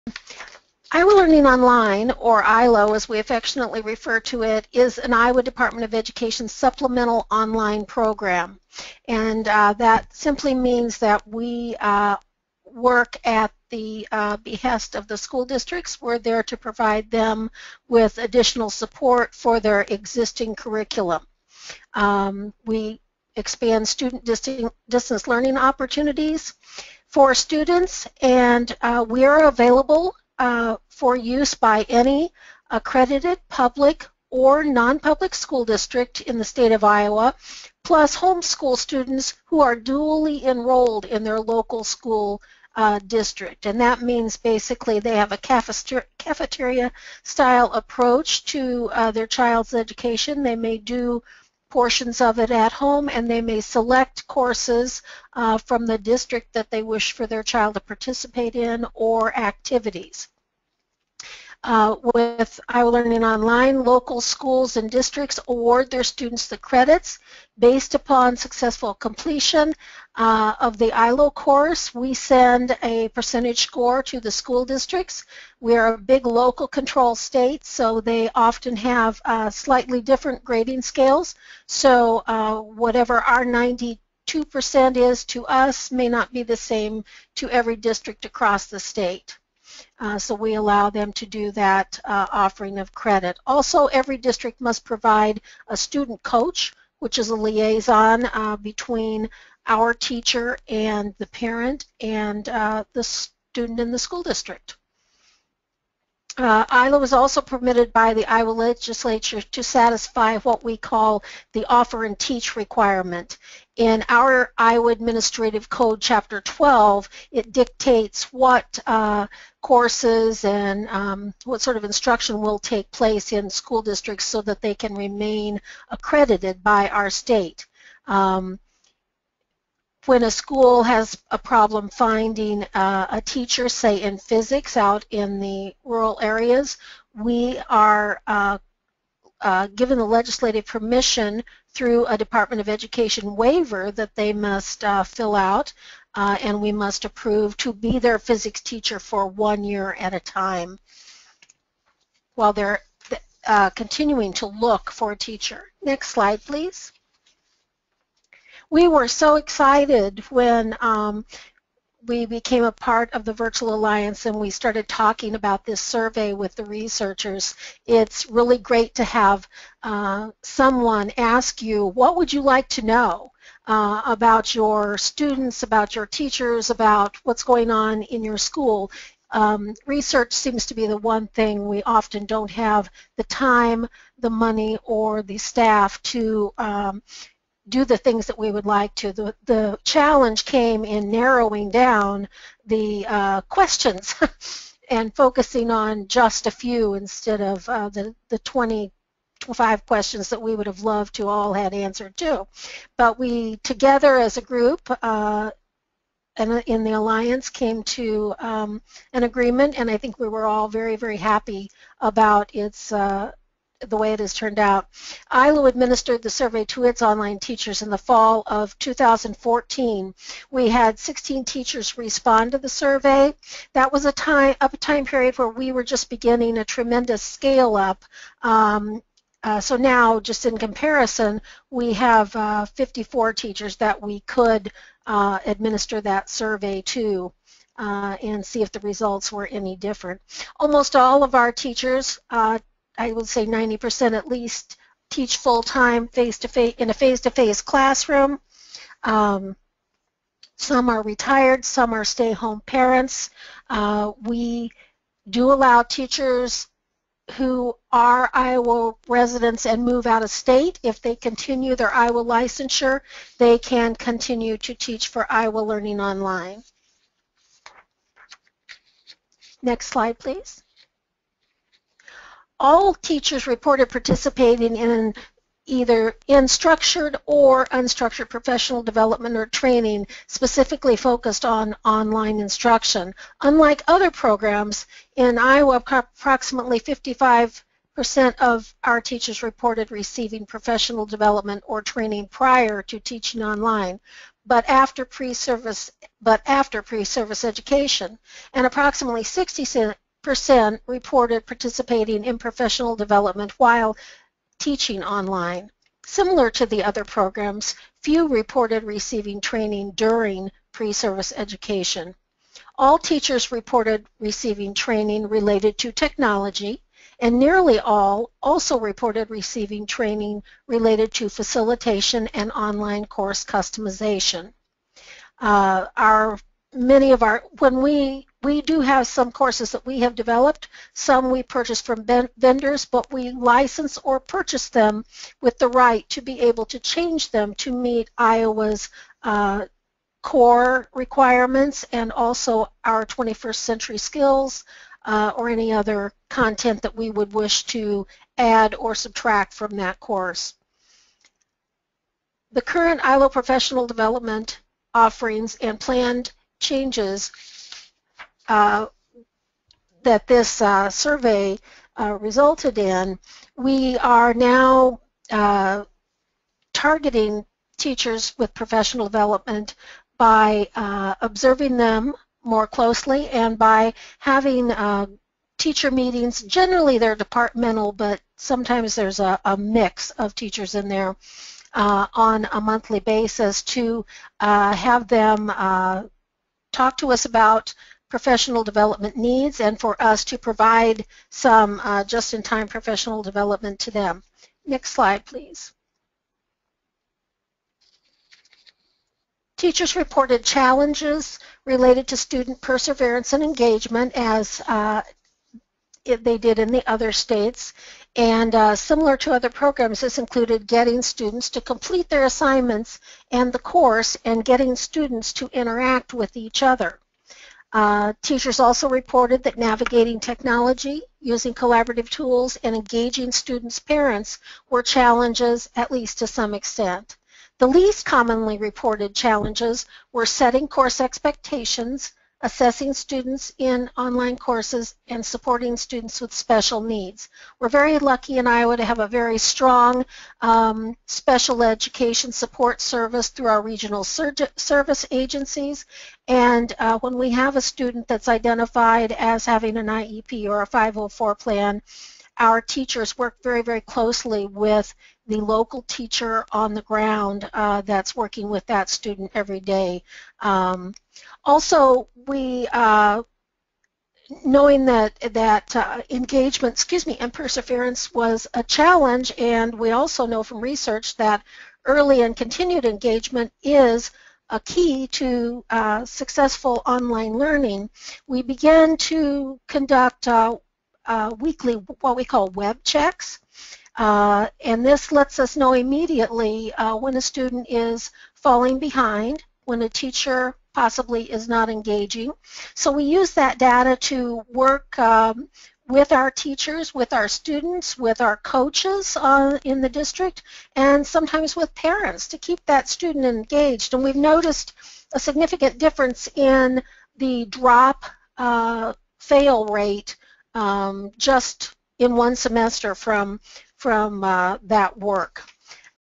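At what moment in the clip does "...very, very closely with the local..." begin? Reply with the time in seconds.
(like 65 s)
453 s.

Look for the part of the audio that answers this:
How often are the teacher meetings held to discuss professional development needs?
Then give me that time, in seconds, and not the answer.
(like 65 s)
382 s.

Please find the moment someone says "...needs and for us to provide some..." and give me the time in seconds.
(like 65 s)
389 s.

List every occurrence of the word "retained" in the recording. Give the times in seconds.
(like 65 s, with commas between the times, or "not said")
not said.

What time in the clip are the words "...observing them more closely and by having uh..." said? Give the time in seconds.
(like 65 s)
371 s.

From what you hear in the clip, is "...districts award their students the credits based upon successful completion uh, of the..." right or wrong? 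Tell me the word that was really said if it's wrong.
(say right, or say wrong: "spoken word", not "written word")
right.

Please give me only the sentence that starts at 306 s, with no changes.
Similar to the other programs, few reported receiving training during pre-service education.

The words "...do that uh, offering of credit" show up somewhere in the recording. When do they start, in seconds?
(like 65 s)
91 s.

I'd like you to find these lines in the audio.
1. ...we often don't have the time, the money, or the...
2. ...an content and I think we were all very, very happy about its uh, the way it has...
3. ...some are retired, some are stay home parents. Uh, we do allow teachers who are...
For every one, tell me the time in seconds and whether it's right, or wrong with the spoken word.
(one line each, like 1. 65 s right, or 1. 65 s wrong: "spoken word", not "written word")
1. 181 s right
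2. 209 s wrong: "agreement", not "content"
3. 250 s right.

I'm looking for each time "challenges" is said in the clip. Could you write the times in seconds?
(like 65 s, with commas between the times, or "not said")
189 s, 400 s, 424 s, 429 s, 468 s.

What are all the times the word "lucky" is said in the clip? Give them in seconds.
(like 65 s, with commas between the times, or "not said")
437 s.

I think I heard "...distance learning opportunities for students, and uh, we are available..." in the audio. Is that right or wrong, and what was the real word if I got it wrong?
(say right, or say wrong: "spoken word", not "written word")
right.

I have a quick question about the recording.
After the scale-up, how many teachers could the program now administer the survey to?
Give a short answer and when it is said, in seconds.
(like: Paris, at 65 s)
54, at 232 s.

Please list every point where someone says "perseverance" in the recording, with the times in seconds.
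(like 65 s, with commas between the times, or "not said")
402 s, 467 s.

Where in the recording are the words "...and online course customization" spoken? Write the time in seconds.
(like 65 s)
322 s.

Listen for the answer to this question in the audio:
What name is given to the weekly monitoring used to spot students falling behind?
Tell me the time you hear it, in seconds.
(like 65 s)
482 s.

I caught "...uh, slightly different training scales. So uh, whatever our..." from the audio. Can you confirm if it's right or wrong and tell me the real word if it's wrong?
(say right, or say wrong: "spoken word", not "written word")
wrong: "grading", not "training".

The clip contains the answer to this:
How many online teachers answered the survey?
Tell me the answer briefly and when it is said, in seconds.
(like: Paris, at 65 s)
16, at 220 s.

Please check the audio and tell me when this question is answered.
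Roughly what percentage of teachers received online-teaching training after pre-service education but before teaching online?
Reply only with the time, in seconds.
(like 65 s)
286 s.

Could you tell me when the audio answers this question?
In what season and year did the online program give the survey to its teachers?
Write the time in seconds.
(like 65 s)
217 s.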